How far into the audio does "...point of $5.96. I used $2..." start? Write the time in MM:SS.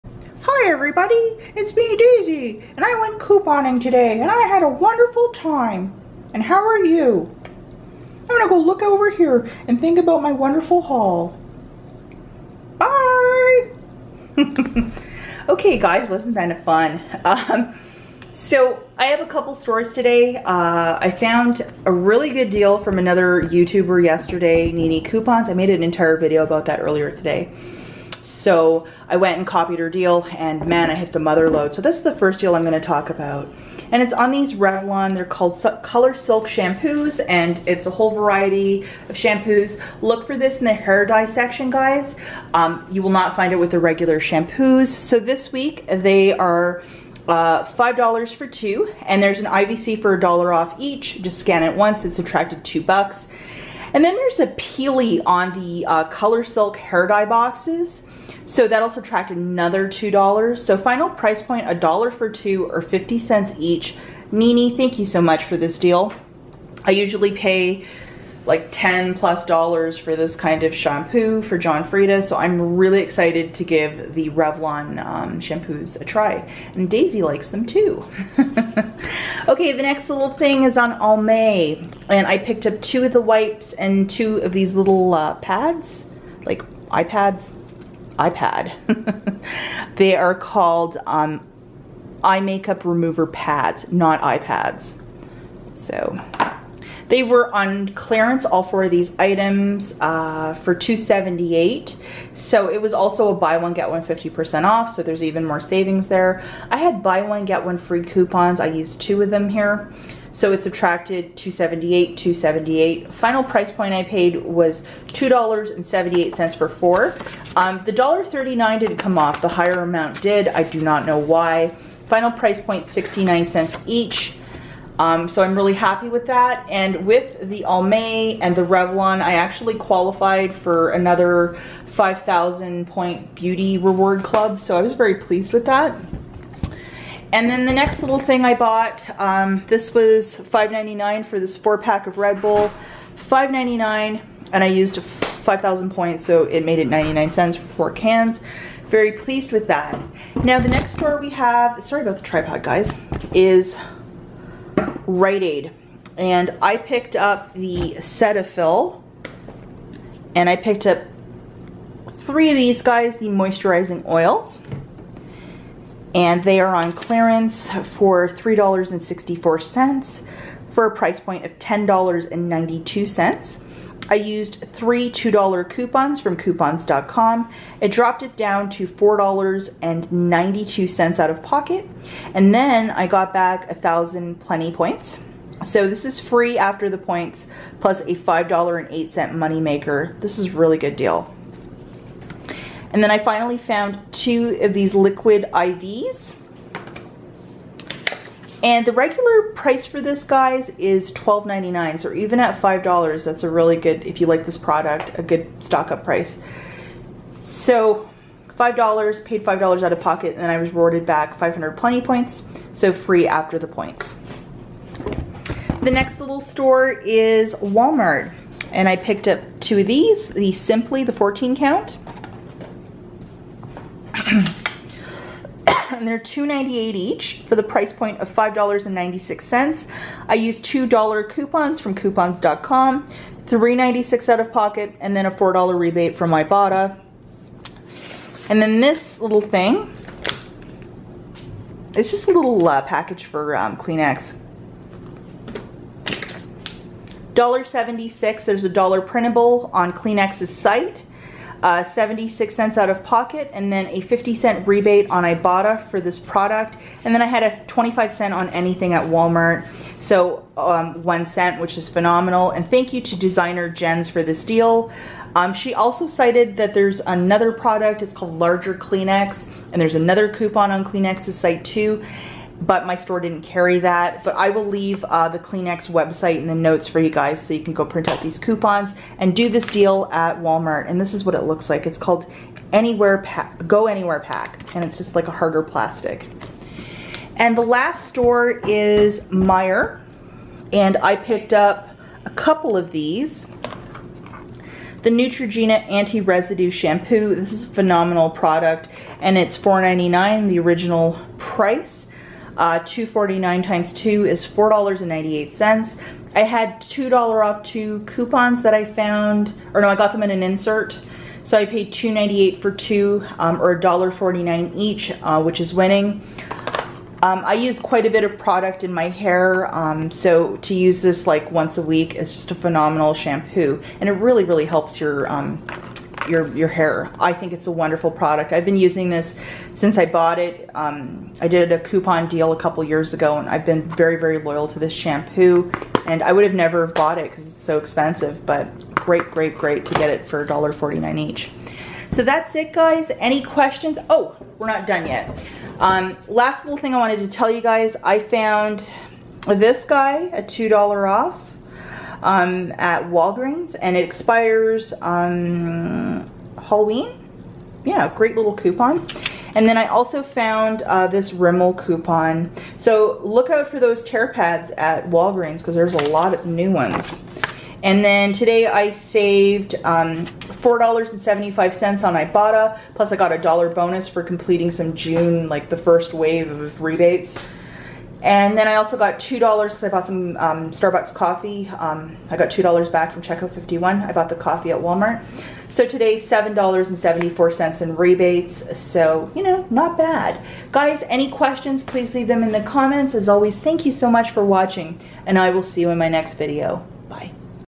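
03:47.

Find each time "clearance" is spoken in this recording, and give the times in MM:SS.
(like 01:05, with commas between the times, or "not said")
01:37, 02:46.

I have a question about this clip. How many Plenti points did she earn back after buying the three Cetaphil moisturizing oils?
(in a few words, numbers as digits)
1000.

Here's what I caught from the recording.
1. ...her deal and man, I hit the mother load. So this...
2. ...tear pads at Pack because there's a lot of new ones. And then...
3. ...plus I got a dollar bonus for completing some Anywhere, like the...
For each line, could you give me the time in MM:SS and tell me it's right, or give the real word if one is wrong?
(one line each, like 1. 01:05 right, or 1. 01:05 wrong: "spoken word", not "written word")
1. 00:29 right
2. 06:04 wrong: "Walgreens", not "Pack"
3. 06:12 wrong: "June", not "Anywhere".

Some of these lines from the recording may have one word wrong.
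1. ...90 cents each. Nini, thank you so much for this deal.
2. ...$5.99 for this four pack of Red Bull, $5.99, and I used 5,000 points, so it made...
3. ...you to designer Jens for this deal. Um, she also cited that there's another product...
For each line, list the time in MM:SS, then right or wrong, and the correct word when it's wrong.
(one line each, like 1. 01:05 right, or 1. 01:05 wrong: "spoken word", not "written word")
1. 01:02 wrong: "50", not "90"
2. 02:20 right
3. 04:22 right.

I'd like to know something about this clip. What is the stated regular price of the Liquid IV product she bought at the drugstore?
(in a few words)
$12.99.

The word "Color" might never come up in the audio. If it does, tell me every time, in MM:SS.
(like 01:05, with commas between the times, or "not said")
00:35, 00:56.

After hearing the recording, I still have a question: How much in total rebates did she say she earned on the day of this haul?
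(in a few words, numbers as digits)
$7.74.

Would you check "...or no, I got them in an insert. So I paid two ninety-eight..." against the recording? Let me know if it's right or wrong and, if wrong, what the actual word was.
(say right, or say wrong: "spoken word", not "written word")
right.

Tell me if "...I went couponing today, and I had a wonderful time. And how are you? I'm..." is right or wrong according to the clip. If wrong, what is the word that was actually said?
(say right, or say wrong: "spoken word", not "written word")
right.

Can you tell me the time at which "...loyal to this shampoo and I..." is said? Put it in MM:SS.
05:34.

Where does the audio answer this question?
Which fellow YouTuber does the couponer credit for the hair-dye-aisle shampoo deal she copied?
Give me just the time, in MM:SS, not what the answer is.
00:24.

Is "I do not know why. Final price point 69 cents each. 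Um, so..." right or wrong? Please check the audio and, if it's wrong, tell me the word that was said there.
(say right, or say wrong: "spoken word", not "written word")
right.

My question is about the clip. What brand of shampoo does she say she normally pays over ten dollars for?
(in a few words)
John Frieda.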